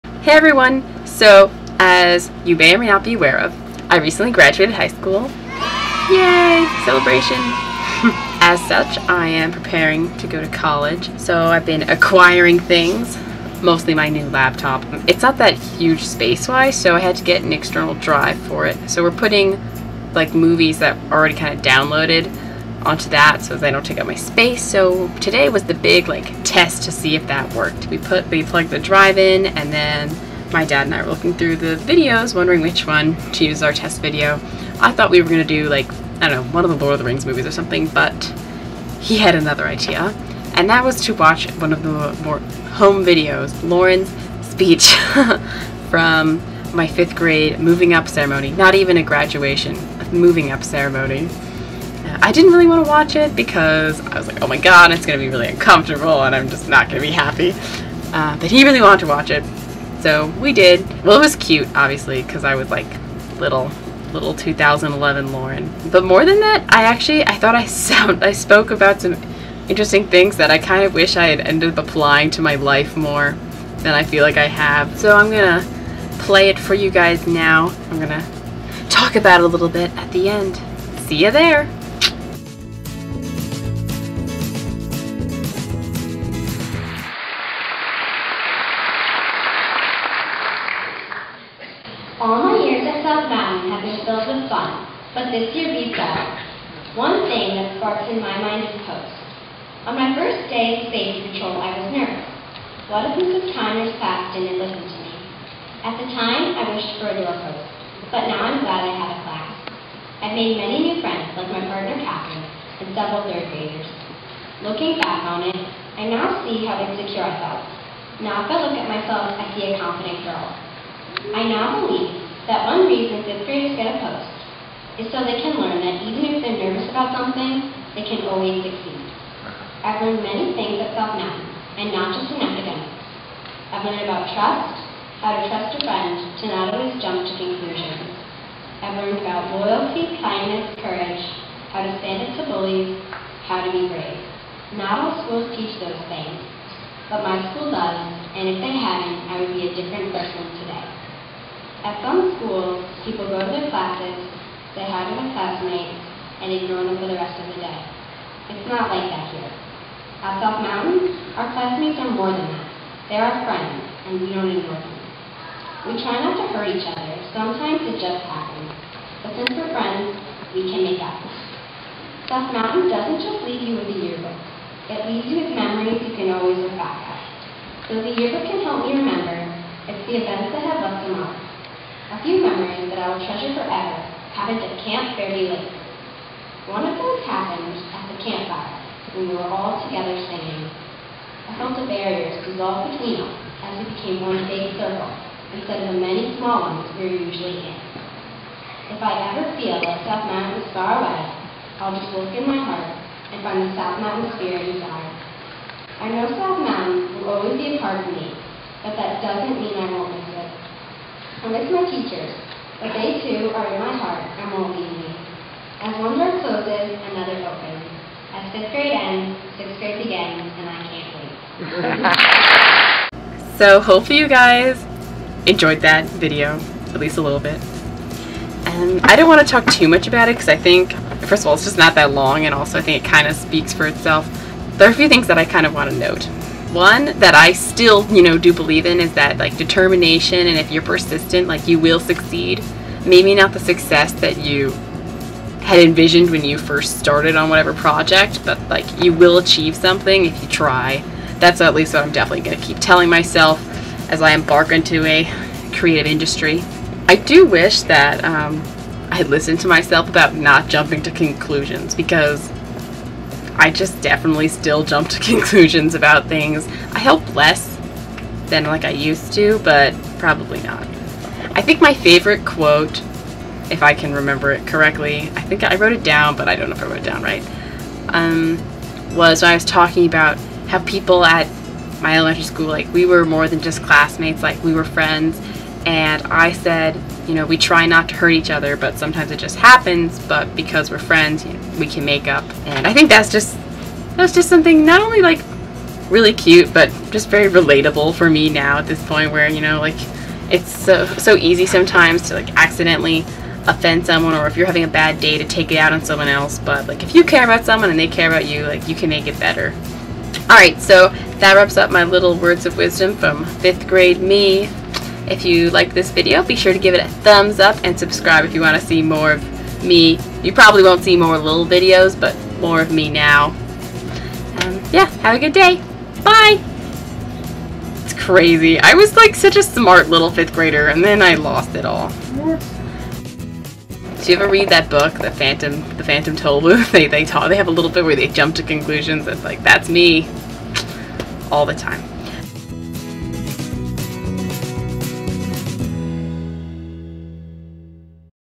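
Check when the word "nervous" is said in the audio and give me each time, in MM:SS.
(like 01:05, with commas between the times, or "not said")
01:41, 02:06.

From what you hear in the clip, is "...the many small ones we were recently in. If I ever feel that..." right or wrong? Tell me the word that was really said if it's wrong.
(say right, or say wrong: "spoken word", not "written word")
wrong: "usually", not "recently".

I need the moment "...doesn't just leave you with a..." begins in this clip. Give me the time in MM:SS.
02:52.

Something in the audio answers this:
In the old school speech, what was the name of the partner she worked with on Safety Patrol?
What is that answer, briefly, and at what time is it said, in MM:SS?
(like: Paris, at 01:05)
Catherine, at 01:52.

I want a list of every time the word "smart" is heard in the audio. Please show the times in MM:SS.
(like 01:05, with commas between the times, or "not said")
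05:29.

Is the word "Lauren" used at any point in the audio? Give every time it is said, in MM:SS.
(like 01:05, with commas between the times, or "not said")
00:43, 01:05.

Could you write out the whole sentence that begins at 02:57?
So the yearbook can help you remember it's the events that have left a mark.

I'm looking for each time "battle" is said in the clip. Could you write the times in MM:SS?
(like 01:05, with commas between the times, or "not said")
not said.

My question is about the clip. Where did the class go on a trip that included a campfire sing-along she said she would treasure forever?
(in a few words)
Camp Fairview Lake.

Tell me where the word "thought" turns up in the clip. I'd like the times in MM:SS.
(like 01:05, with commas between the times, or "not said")
00:34, 01:07.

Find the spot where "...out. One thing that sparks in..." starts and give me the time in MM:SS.
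01:36.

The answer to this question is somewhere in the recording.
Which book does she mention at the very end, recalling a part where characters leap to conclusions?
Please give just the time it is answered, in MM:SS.
05:35.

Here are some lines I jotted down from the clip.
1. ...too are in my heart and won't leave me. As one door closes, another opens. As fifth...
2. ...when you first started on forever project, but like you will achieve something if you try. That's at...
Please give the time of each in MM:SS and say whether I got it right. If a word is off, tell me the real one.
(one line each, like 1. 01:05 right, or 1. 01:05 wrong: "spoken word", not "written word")
1. 03:33 right
2. 04:06 wrong: "whatever", not "forever".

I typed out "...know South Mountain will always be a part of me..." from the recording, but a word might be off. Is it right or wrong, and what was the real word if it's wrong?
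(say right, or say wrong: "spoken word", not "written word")
right.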